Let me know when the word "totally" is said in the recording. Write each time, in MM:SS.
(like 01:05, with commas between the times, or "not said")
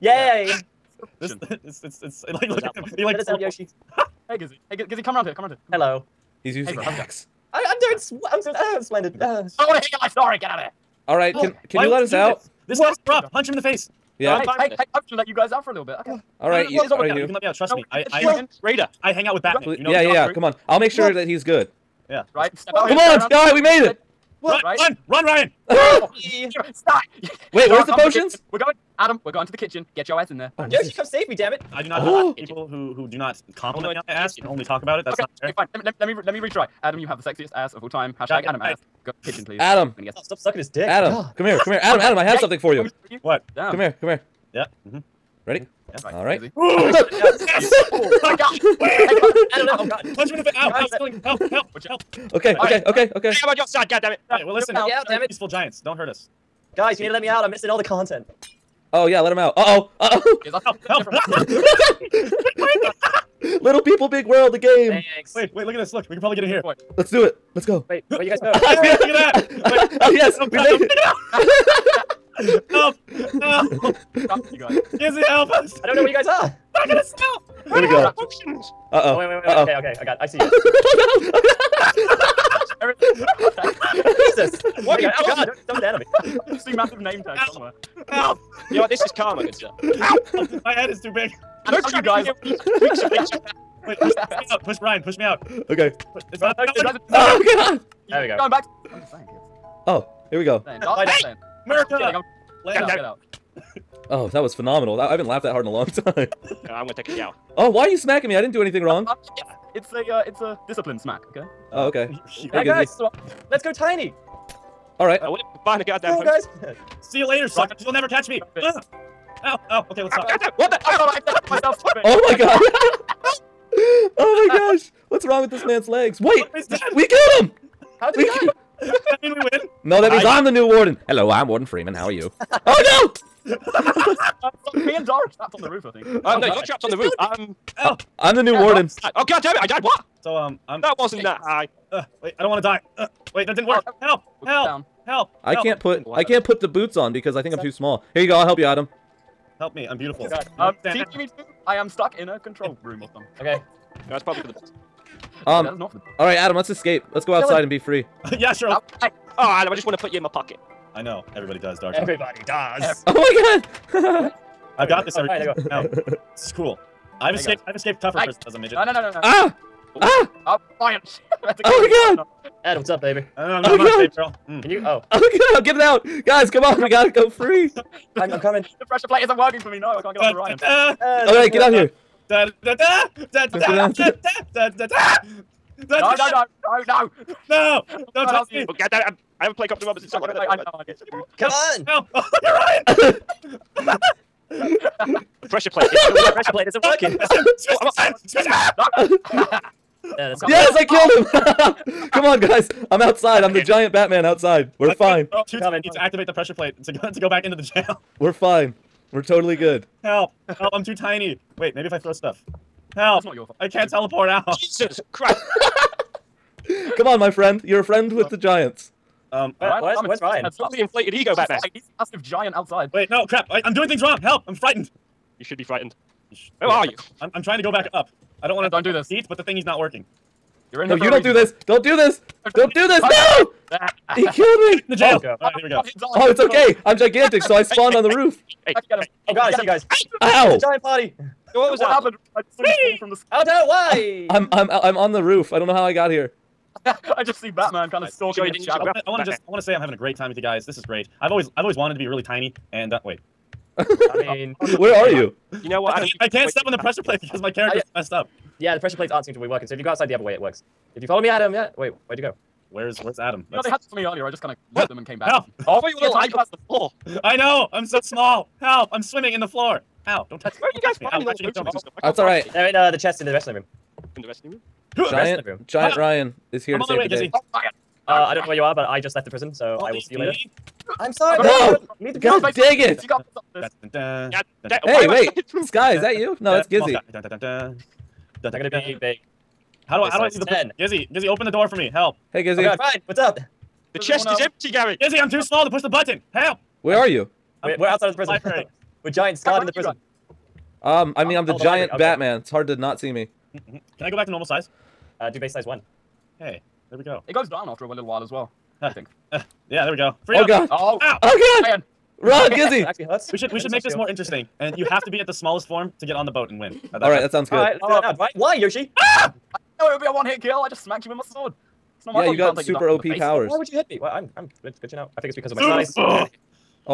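03:29, 03:40.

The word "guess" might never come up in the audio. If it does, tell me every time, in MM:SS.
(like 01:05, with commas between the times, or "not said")
00:40, 03:10.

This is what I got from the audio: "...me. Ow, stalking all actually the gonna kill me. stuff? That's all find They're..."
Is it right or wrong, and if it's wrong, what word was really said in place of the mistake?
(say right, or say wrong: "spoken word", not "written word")
wrong: "finding", not "stalking".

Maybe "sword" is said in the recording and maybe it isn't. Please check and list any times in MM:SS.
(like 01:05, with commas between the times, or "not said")
05:21.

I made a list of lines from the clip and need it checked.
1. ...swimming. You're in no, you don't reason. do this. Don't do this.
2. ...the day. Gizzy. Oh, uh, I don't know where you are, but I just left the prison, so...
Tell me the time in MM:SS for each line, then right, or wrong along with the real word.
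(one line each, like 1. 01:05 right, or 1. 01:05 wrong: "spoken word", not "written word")
1. 03:49 wrong: "working", not "swimming"
2. 04:37 right.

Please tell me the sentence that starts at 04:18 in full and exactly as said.
Yeah, the pressure plates aren't seem to be working.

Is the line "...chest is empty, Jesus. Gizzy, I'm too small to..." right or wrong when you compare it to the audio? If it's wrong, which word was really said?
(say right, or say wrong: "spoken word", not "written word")
wrong: "Gary", not "Jesus".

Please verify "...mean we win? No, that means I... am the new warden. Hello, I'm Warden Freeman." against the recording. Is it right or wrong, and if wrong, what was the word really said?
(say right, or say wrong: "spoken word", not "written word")
right.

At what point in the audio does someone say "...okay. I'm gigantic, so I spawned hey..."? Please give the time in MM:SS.
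03:56.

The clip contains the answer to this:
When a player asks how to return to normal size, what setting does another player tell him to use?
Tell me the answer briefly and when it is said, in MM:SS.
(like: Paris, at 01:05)
base size one, at 05:05.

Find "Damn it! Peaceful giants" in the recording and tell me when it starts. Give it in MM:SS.
00:55.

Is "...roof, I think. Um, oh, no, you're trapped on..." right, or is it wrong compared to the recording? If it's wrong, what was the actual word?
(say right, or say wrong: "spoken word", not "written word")
right.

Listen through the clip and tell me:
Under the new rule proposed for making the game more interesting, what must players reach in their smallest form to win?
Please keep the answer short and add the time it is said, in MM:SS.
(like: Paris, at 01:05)
the boat, at 05:16.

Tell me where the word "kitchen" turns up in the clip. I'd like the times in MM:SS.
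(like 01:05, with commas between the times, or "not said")
00:29, 00:39.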